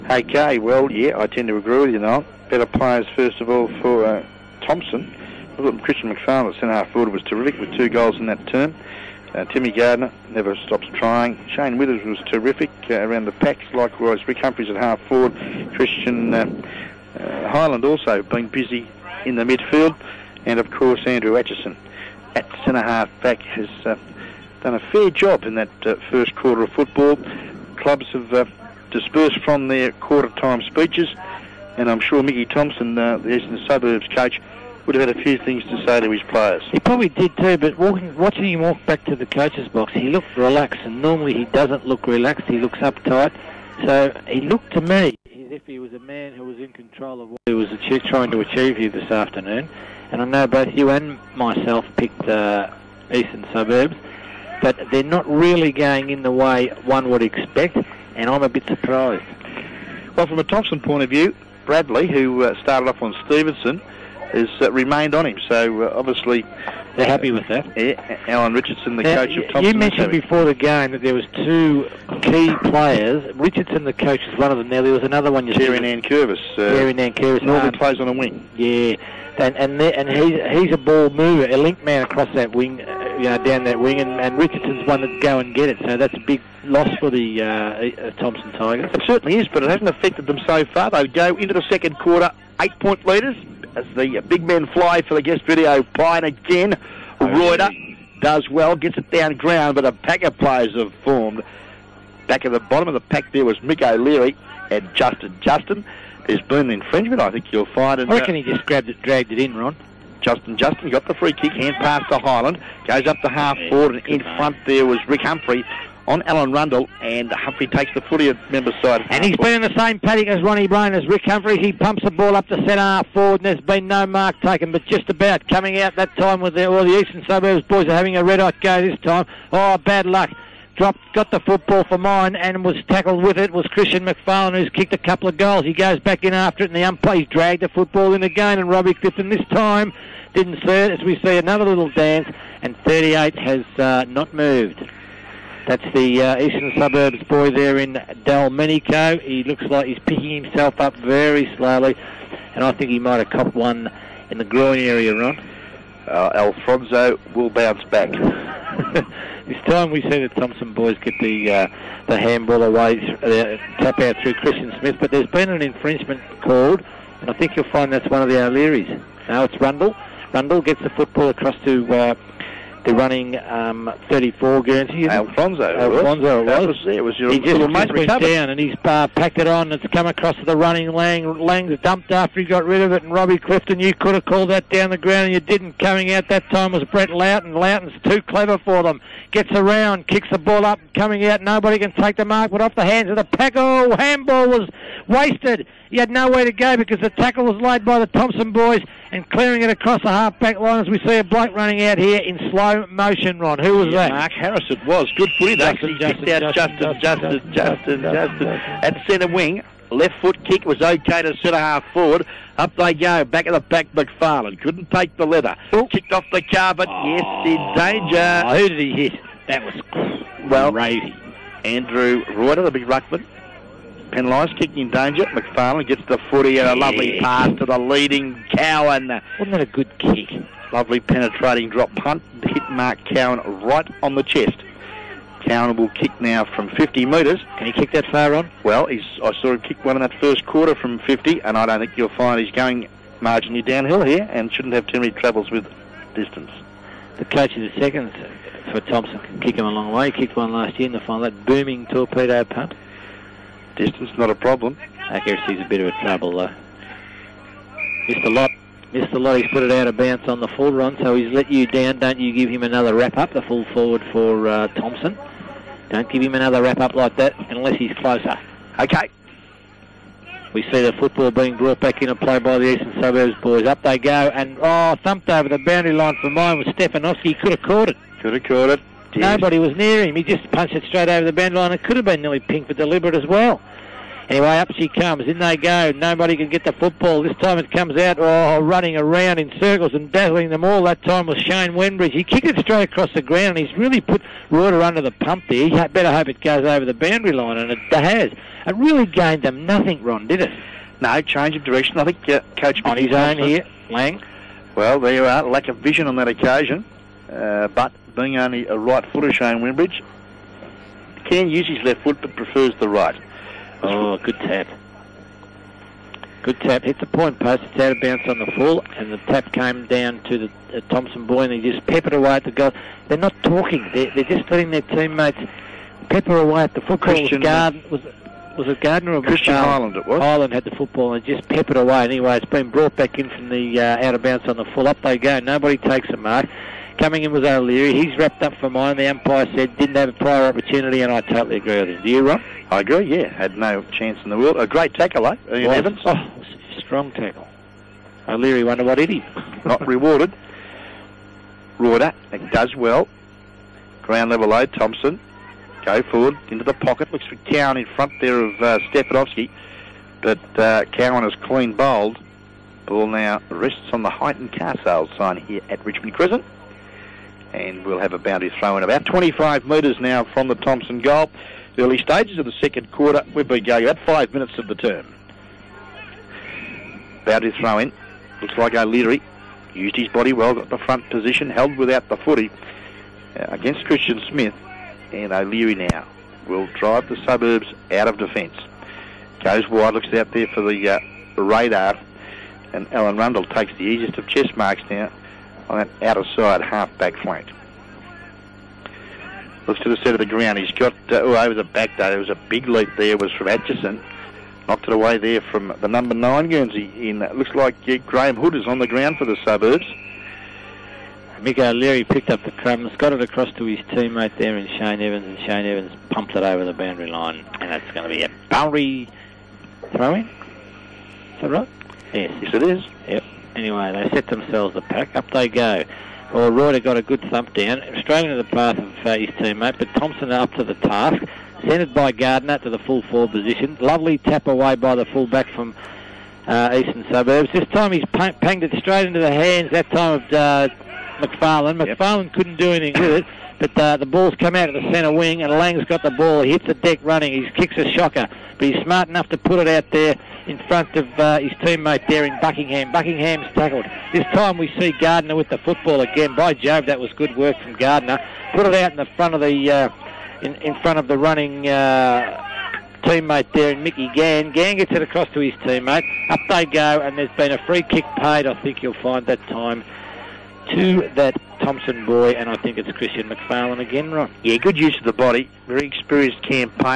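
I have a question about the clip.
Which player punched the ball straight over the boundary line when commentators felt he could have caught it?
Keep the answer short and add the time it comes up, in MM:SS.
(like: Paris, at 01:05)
Stefanowski, at 04:36.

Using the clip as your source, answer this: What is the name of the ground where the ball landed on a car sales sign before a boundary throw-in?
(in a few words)
Richmond Crescent.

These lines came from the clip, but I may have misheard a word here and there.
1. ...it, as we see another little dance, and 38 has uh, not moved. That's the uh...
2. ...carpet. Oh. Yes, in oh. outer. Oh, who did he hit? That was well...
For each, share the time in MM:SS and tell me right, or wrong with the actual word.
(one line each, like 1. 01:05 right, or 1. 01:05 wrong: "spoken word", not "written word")
1. 02:20 right
2. 03:36 wrong: "danger", not "outer".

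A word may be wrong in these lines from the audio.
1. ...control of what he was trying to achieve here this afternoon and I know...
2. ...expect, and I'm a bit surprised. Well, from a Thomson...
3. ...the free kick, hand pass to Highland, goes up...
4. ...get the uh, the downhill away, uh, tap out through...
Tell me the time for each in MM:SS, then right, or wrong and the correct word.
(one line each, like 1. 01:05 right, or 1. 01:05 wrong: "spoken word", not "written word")
1. 00:46 right
2. 00:57 right
3. 01:51 right
4. 02:40 wrong: "handball", not "downhill".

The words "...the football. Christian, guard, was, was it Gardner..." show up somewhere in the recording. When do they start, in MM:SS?
05:26.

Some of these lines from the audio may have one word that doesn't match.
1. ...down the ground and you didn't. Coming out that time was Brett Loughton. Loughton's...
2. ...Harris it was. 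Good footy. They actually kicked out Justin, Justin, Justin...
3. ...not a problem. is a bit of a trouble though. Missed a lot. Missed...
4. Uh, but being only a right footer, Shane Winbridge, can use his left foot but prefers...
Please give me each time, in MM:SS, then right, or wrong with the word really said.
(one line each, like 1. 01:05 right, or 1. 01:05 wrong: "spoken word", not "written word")
1. 03:04 right
2. 03:24 right
3. 04:14 right
4. 05:07 right.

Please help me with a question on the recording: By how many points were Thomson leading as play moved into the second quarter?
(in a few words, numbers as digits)
8.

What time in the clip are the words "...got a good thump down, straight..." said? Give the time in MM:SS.
07:06.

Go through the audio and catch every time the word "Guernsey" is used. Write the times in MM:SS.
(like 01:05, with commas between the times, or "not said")
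02:54, 06:46.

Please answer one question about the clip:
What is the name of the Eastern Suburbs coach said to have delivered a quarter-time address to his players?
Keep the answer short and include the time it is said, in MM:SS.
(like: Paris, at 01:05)
Mickey Thompson, at 00:32.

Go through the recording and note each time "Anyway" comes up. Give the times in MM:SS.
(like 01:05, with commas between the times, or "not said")
04:44, 05:32, 07:03.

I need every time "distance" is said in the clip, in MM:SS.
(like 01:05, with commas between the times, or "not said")
04:06, 04:13.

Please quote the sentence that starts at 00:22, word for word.
At centre half back has uh, done a fair job in that uh, first quarter of football.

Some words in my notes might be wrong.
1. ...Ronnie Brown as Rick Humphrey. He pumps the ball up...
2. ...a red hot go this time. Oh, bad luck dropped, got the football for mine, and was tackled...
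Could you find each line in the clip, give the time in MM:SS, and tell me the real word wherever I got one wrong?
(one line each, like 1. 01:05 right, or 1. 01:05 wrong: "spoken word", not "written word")
1. 02:00 right
2. 02:08 right.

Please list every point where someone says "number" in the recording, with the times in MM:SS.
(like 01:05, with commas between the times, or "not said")
06:45.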